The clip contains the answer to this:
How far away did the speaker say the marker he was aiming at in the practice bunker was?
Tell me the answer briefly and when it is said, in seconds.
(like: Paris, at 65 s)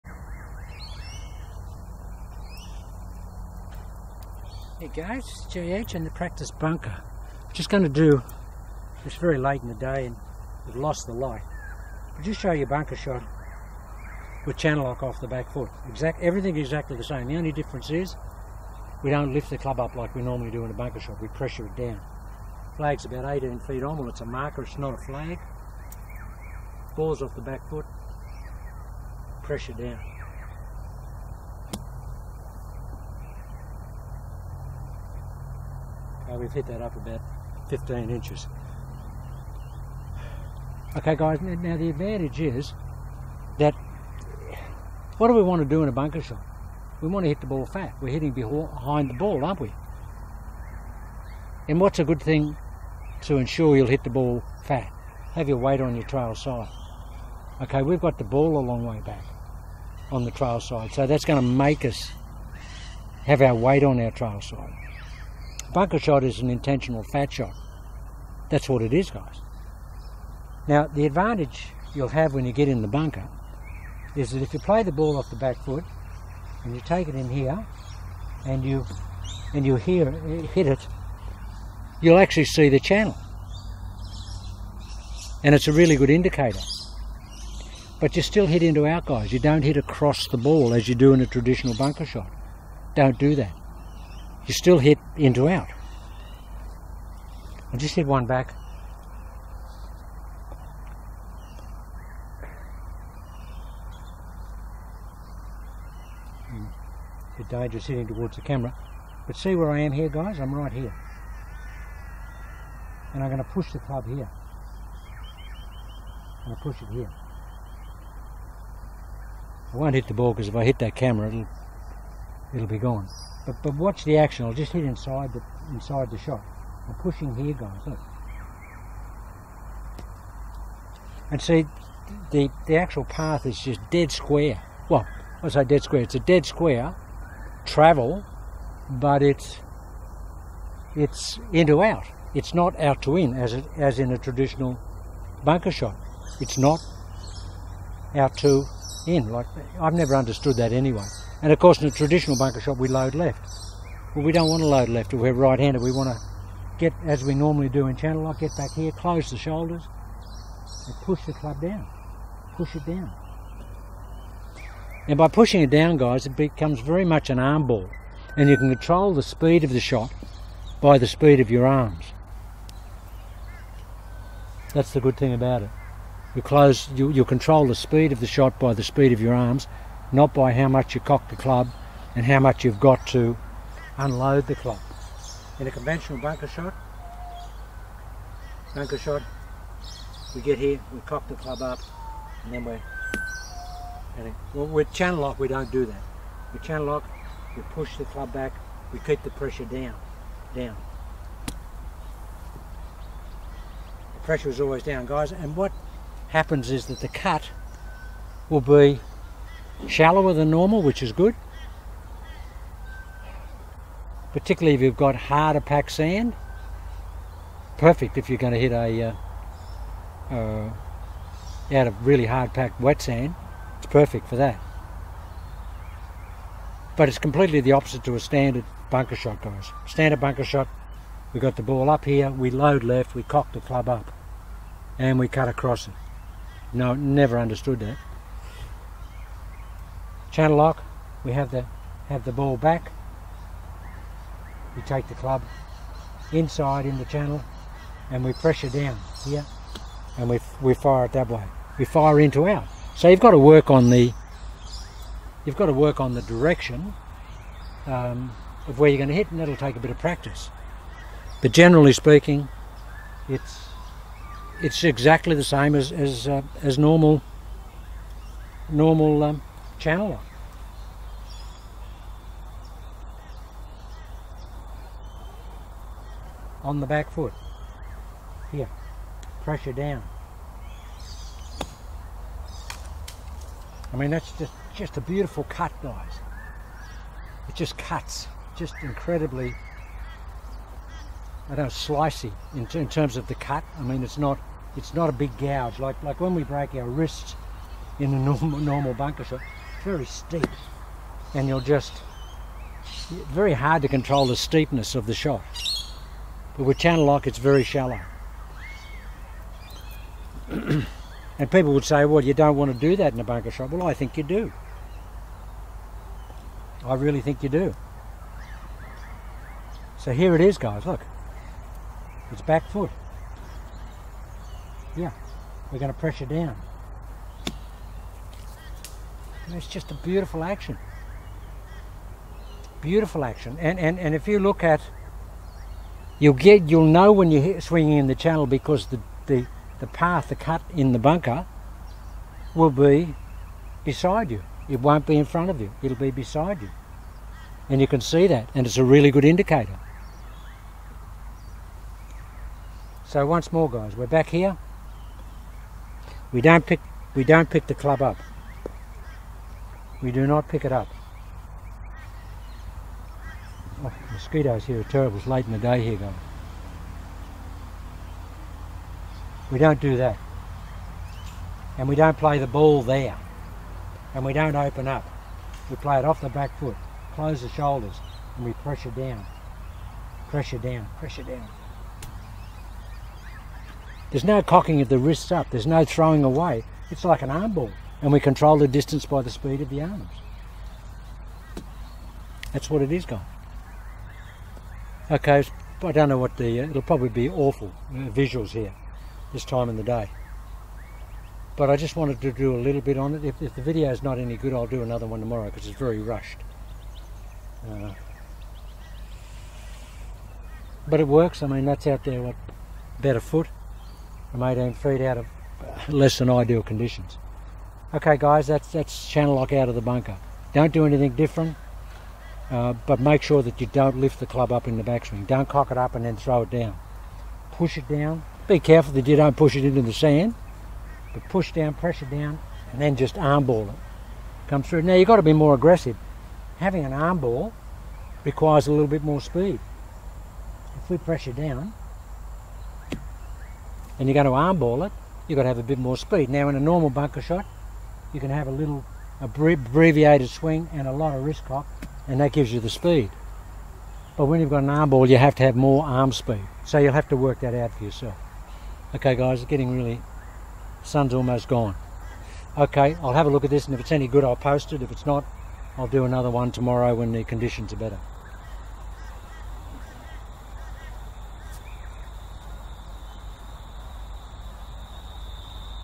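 18 feet, at 23 s.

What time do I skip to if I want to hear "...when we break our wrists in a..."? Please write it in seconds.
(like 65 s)
296 s.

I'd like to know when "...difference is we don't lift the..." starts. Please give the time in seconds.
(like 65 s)
17 s.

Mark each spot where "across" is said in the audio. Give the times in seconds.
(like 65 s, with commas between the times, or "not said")
89 s, 235 s.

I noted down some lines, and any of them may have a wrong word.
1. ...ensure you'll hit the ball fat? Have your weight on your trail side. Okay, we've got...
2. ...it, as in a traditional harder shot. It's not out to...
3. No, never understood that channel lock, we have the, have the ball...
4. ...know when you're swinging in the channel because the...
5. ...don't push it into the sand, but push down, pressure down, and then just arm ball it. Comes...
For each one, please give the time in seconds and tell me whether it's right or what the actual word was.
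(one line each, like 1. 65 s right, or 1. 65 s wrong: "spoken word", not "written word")
1. 53 s right
2. 143 s wrong: "bunker", not "harder"
3. 236 s right
4. 336 s right
5. 429 s right.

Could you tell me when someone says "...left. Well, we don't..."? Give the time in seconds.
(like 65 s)
153 s.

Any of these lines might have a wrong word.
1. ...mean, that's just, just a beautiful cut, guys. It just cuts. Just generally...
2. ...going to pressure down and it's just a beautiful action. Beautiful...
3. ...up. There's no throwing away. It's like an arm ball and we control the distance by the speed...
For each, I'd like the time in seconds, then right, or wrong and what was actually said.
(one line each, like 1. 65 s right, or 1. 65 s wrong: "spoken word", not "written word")
1. 283 s wrong: "incredibly", not "generally"
2. 325 s right
3. 385 s right.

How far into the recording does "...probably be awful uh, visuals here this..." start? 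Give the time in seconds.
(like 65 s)
396 s.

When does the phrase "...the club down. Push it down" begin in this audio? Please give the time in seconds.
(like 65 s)
161 s.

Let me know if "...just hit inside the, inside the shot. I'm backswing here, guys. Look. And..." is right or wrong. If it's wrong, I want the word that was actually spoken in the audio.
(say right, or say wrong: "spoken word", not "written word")
wrong: "pushing", not "backswing".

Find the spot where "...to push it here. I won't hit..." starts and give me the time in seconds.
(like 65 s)
116 s.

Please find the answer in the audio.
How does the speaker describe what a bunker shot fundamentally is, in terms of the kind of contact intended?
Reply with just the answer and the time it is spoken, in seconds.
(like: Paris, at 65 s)
an intentional fat shot, at 66 s.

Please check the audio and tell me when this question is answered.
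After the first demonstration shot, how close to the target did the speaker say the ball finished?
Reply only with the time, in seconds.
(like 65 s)
37 s.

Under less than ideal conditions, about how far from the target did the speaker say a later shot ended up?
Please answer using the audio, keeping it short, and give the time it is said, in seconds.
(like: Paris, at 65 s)
about a foot, at 412 s.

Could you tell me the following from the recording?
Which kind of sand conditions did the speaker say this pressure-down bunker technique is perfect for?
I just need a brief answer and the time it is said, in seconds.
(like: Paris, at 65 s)
hard packed wet sand, at 222 s.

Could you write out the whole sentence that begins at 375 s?
We play it off the back foot, close the shoulders, and we pressure down.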